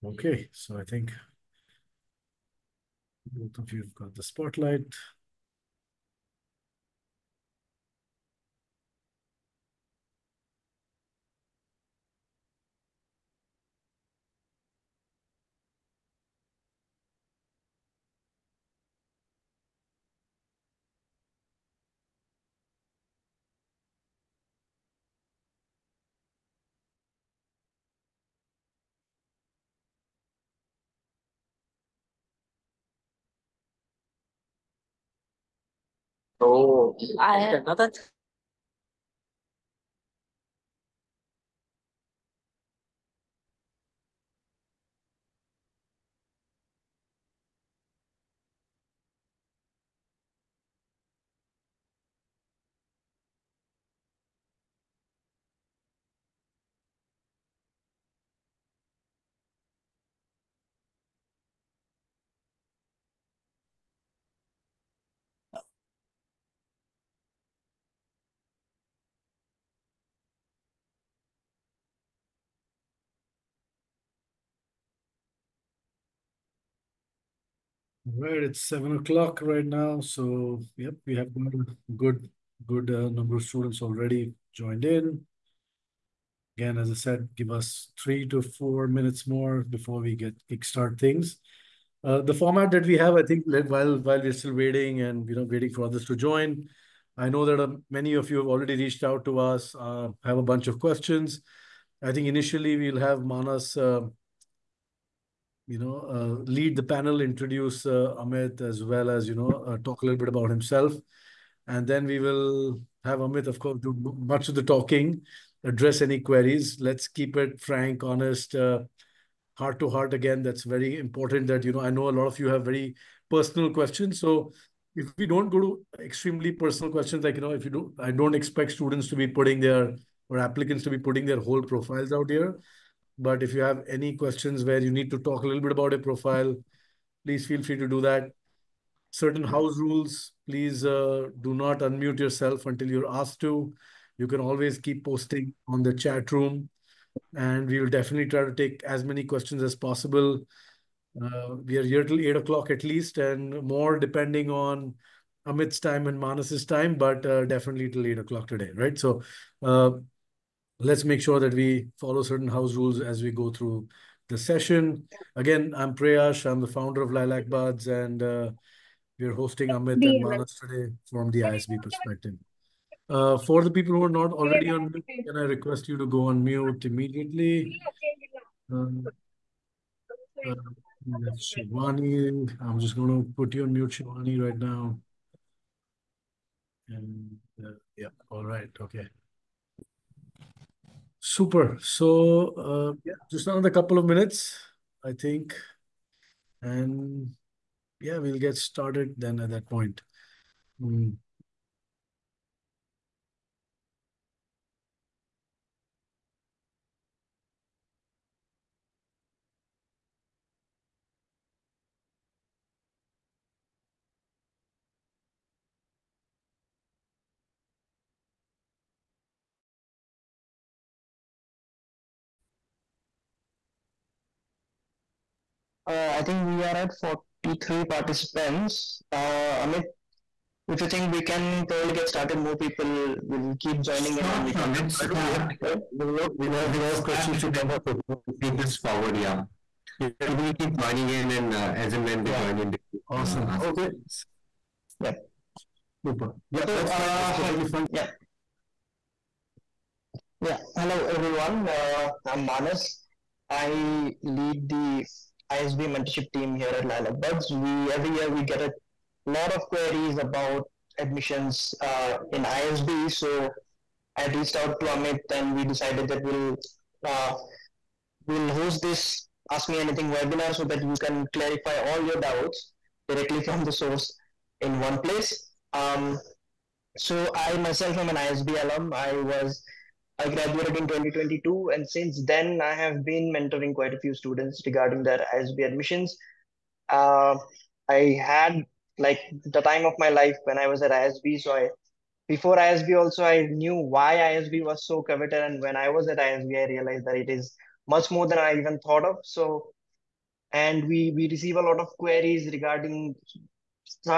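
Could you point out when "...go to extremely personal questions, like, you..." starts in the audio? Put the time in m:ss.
2:05.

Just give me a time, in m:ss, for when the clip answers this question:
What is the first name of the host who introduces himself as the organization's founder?
2:45.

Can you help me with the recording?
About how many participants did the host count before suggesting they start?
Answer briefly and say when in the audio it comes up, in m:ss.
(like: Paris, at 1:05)
43, at 3:46.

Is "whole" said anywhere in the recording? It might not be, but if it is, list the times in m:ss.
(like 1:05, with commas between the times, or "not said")
2:11.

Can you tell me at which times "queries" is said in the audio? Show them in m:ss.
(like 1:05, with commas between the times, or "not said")
1:56, 4:19, 5:01.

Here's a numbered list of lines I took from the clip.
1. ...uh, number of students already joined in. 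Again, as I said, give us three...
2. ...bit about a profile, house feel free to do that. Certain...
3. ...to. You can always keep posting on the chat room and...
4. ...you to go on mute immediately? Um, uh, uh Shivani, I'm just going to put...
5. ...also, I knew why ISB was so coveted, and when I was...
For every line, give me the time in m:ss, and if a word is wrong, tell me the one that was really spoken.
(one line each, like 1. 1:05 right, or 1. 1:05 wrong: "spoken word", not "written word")
1. 1:22 right
2. 2:15 wrong: "please", not "house"
3. 2:23 right
4. 2:55 right
5. 4:52 right.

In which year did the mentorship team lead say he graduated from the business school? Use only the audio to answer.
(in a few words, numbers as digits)
2022.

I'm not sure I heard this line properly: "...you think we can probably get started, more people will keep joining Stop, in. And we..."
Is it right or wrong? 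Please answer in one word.
right.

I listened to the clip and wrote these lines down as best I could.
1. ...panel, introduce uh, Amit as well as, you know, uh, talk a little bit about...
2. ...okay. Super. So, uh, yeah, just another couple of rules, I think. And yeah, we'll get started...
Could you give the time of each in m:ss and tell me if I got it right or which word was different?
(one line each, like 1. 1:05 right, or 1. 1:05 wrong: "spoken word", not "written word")
1. 1:46 right
2. 3:08 wrong: "minutes", not "rules".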